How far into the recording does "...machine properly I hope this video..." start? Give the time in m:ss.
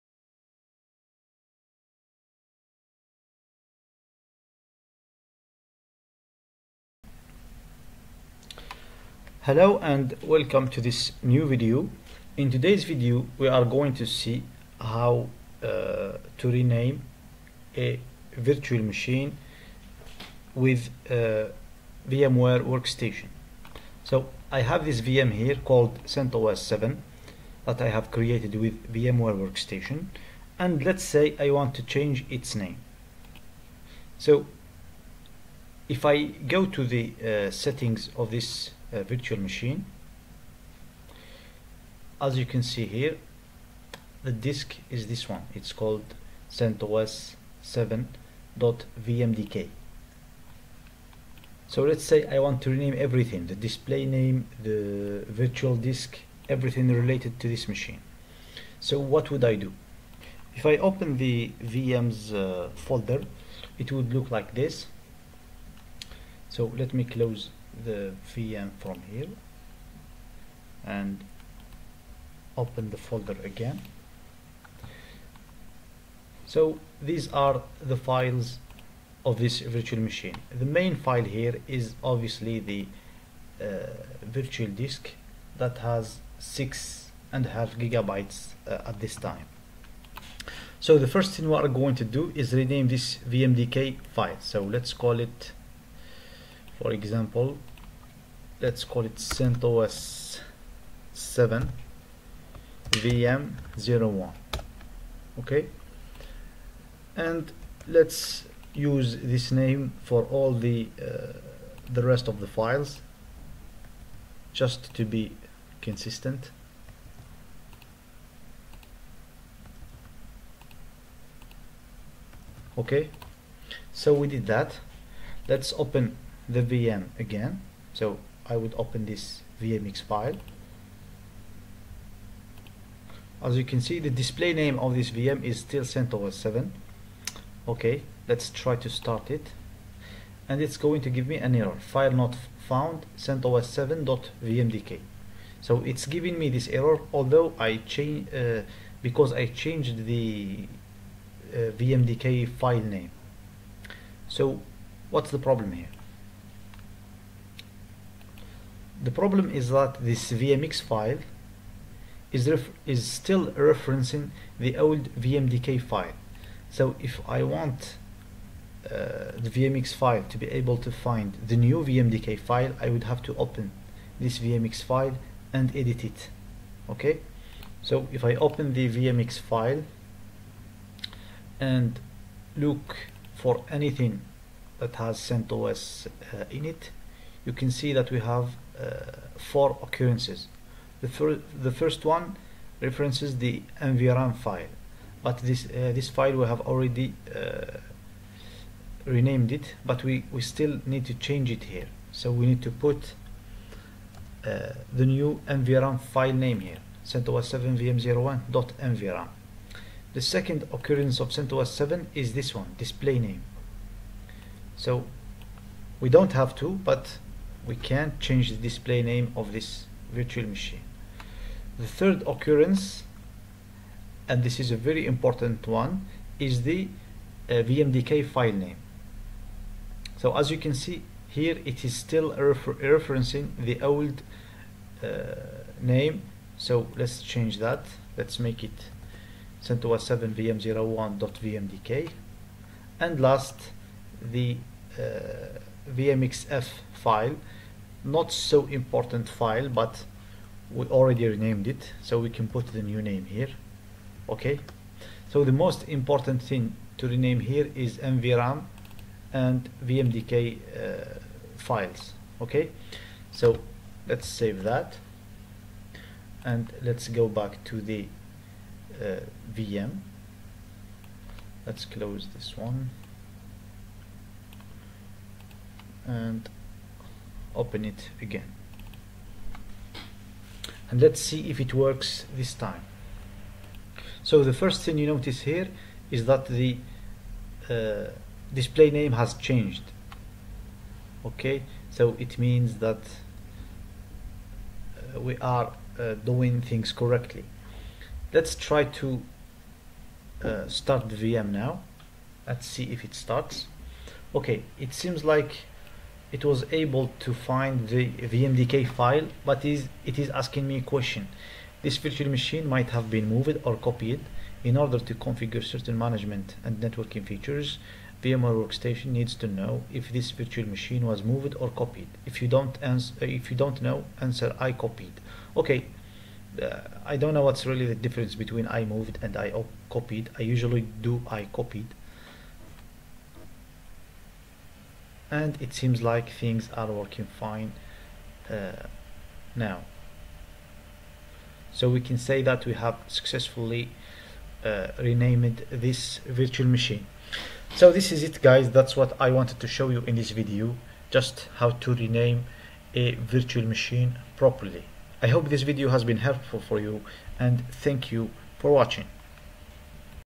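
5:53.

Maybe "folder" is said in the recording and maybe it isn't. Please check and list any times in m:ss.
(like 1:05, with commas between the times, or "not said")
1:02, 1:12.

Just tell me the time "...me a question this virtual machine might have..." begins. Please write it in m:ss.
5:10.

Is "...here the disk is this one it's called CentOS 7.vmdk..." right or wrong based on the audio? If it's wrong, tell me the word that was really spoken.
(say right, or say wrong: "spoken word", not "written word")
right.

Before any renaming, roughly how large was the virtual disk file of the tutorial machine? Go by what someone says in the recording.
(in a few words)
6.5 gigabytes.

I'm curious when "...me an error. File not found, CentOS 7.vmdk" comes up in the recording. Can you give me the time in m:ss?
2:21.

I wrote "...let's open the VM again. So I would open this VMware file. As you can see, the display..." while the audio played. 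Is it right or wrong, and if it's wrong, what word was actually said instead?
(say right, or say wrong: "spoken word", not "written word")
wrong: "VMX", not "VMware".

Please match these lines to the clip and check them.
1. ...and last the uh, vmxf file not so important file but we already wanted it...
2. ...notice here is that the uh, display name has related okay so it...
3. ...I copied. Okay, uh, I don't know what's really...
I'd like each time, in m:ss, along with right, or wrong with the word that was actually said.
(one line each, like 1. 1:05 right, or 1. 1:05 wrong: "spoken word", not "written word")
1. 4:02 wrong: "renamed", not "wanted"
2. 4:45 wrong: "changed", not "related"
3. 5:24 right.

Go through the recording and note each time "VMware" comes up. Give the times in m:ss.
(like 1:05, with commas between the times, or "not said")
0:21, 0:28, 5:18.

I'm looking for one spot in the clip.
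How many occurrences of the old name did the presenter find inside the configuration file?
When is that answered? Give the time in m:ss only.
3:09.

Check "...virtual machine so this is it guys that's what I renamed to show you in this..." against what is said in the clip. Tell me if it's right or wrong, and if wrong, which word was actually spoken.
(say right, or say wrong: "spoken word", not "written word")
wrong: "wanted", not "renamed".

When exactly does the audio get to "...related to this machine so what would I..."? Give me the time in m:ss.
0:56.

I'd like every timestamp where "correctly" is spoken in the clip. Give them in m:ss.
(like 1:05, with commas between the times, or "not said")
4:56.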